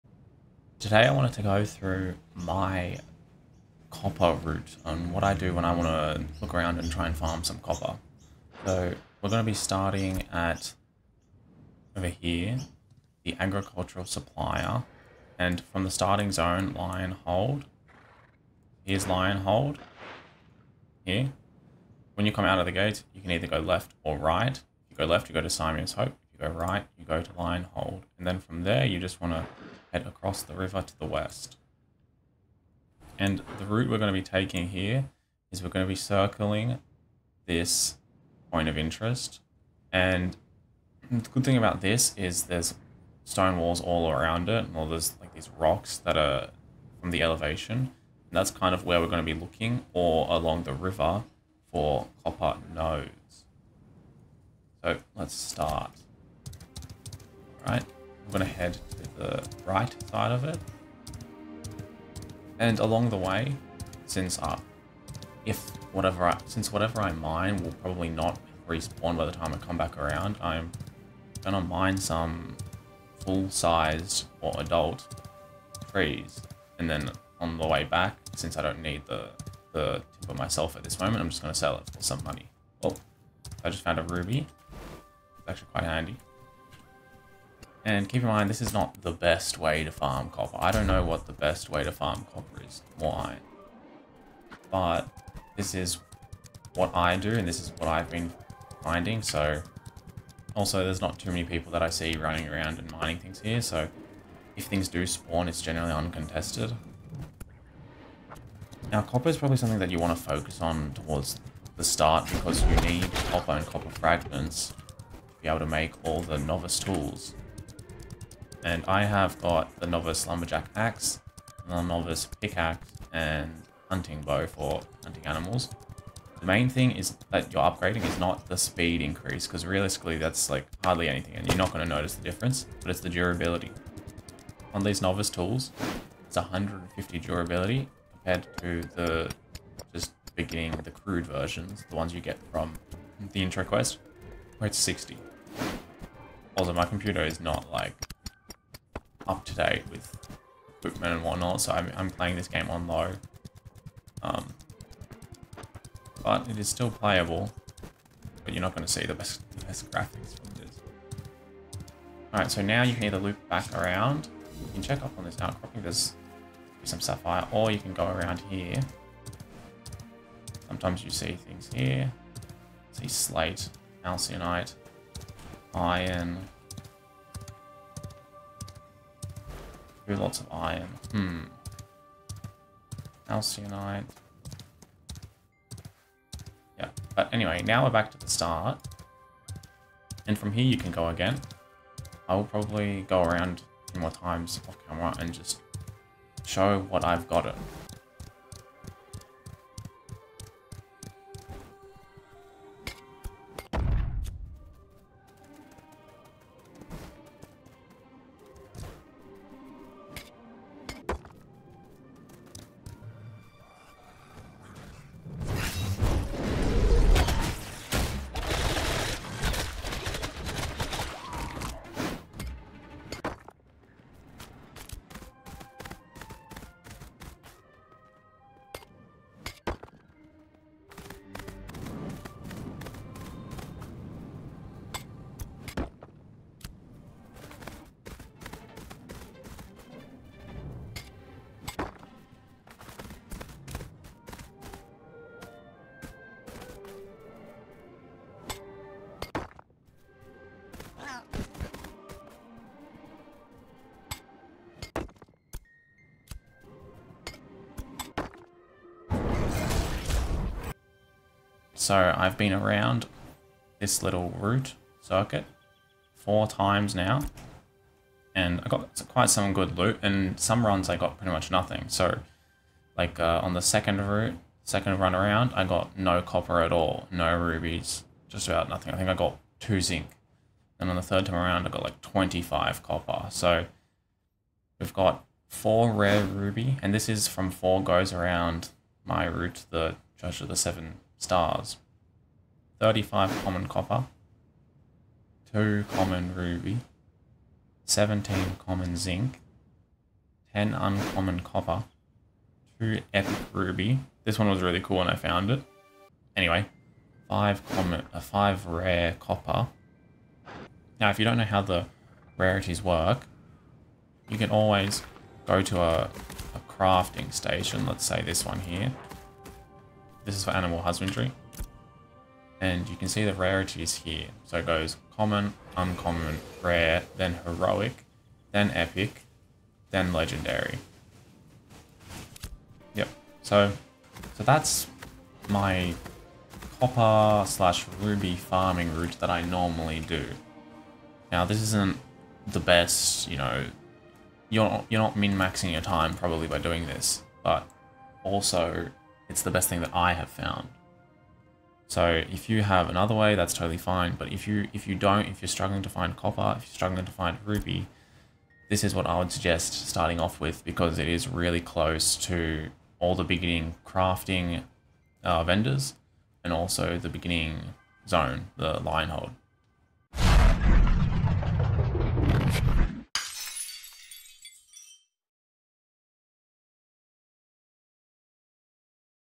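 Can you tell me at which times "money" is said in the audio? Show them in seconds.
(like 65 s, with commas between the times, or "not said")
82 s.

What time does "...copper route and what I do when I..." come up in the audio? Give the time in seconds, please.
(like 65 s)
3 s.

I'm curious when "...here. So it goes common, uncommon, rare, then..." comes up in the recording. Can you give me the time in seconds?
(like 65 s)
323 s.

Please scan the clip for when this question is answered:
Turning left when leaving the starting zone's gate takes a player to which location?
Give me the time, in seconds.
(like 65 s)
25 s.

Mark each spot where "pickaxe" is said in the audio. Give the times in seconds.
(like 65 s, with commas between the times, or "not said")
122 s.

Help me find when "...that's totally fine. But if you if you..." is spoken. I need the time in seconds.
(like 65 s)
353 s.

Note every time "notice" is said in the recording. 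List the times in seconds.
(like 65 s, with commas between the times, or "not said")
131 s.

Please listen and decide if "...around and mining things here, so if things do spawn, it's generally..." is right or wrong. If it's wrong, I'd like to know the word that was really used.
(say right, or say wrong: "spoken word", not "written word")
right.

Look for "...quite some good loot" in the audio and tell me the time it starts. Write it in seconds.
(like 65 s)
269 s.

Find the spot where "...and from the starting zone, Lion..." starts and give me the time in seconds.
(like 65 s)
15 s.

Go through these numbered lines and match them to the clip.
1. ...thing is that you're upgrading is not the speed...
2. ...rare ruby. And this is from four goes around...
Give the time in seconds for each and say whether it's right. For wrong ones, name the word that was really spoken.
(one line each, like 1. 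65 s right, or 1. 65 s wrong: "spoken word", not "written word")
1. 126 s right
2. 285 s right.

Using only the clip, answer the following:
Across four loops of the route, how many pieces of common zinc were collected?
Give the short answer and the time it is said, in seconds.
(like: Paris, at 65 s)
17, at 297 s.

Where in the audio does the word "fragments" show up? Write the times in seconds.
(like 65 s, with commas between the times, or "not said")
113 s.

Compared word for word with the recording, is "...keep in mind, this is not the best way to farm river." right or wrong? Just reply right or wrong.
wrong.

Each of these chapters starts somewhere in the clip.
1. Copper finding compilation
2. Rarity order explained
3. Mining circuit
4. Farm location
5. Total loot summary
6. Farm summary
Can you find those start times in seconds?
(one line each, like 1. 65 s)
1. 196 s
2. 310 s
3. 55 s
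4. 10 s
5. 260 s
6. 332 s.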